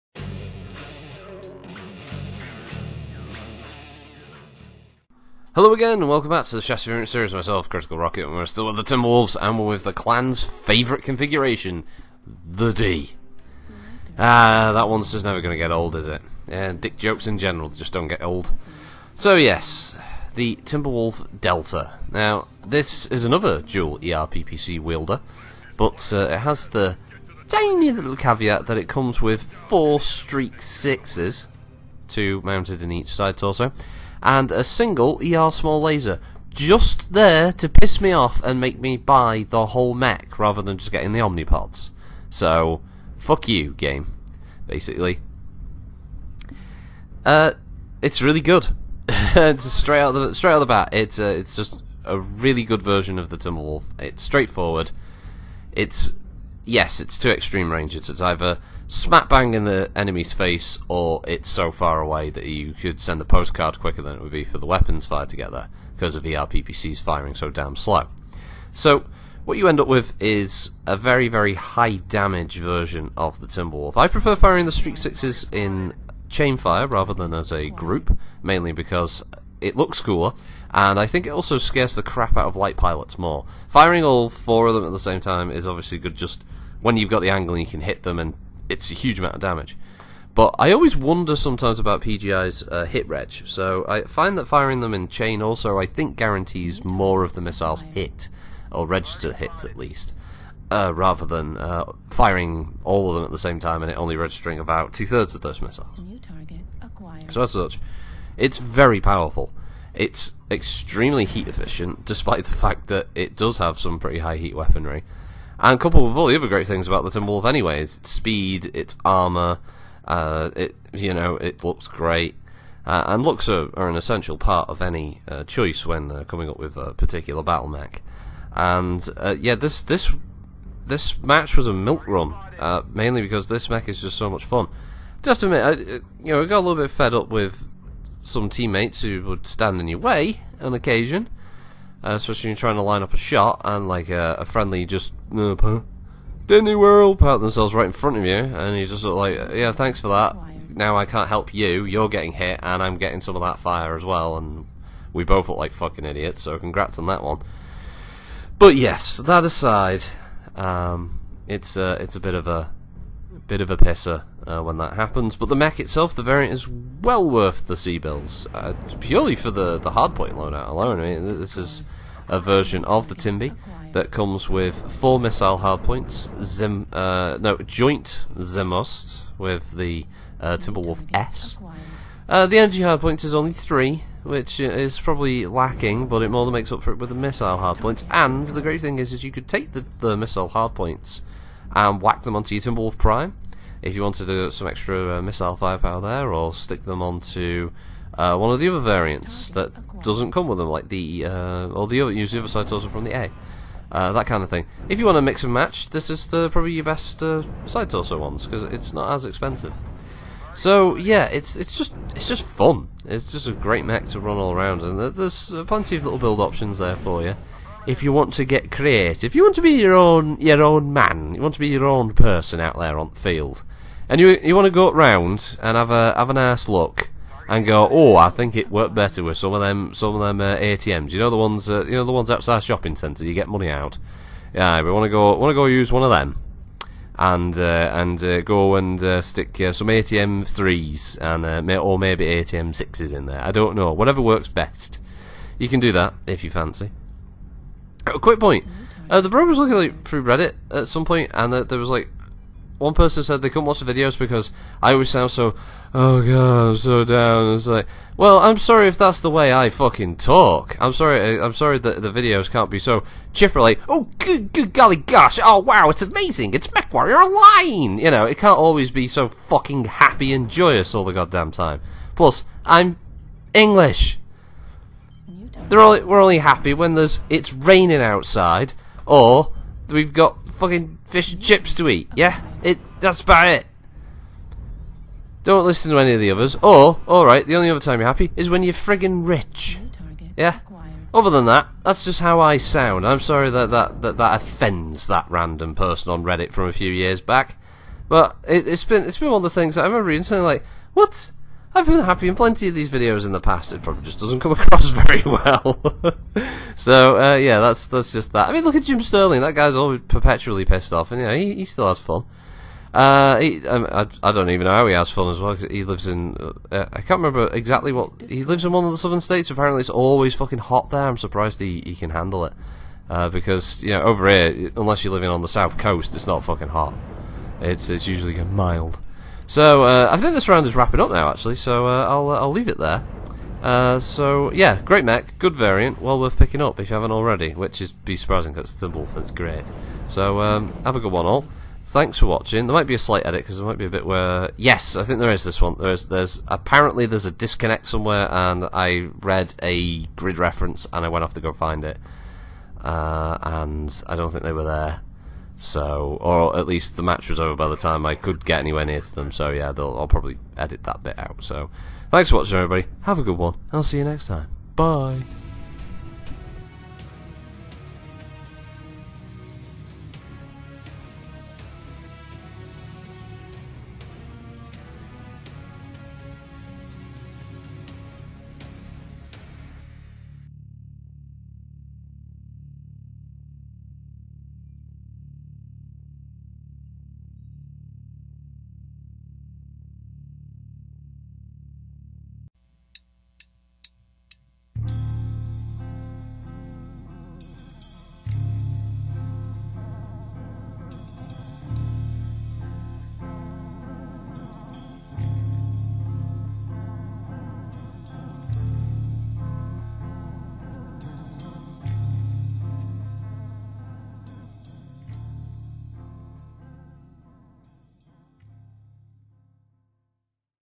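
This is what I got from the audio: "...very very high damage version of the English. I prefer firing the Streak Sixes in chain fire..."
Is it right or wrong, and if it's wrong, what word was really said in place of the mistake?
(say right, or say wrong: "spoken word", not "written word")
wrong: "Timberwolf", not "English".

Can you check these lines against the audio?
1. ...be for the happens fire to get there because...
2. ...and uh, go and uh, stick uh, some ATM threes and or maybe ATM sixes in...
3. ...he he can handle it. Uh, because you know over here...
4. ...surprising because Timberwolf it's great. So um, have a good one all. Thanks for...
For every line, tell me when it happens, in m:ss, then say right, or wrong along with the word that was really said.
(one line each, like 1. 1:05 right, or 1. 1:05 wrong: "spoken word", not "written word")
1. 1:04 wrong: "weapons", not "happens"
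2. 3:57 right
3. 5:21 right
4. 5:38 right.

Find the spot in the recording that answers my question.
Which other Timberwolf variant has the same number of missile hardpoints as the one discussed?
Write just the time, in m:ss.
3:00.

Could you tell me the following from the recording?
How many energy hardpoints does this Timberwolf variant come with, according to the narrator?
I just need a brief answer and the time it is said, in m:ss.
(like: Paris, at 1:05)
3, at 3:03.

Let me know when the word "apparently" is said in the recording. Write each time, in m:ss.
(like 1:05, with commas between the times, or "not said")
5:19, 5:46.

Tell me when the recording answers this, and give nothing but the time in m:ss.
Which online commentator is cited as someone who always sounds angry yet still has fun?
5:08.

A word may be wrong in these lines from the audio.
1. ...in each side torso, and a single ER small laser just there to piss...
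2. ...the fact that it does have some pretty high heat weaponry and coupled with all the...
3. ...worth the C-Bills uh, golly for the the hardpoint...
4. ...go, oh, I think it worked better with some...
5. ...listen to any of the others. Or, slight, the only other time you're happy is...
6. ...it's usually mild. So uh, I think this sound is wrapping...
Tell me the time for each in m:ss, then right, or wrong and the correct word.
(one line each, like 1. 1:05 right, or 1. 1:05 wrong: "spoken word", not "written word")
1. 0:32 right
2. 1:52 right
3. 2:47 wrong: "purely", not "golly"
4. 3:47 right
5. 4:45 wrong: "alright", not "slight"
6. 5:27 wrong: "round", not "sound".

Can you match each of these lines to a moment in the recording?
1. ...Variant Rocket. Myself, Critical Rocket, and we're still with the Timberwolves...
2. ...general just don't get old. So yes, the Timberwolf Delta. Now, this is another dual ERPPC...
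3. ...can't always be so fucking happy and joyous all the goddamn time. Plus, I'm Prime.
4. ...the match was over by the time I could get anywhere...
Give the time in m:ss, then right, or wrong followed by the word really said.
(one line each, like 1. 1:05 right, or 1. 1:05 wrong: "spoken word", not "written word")
1. 0:06 wrong: "Series", not "Rocket"
2. 0:17 right
3. 4:28 wrong: "English", not "Prime"
4. 5:56 right.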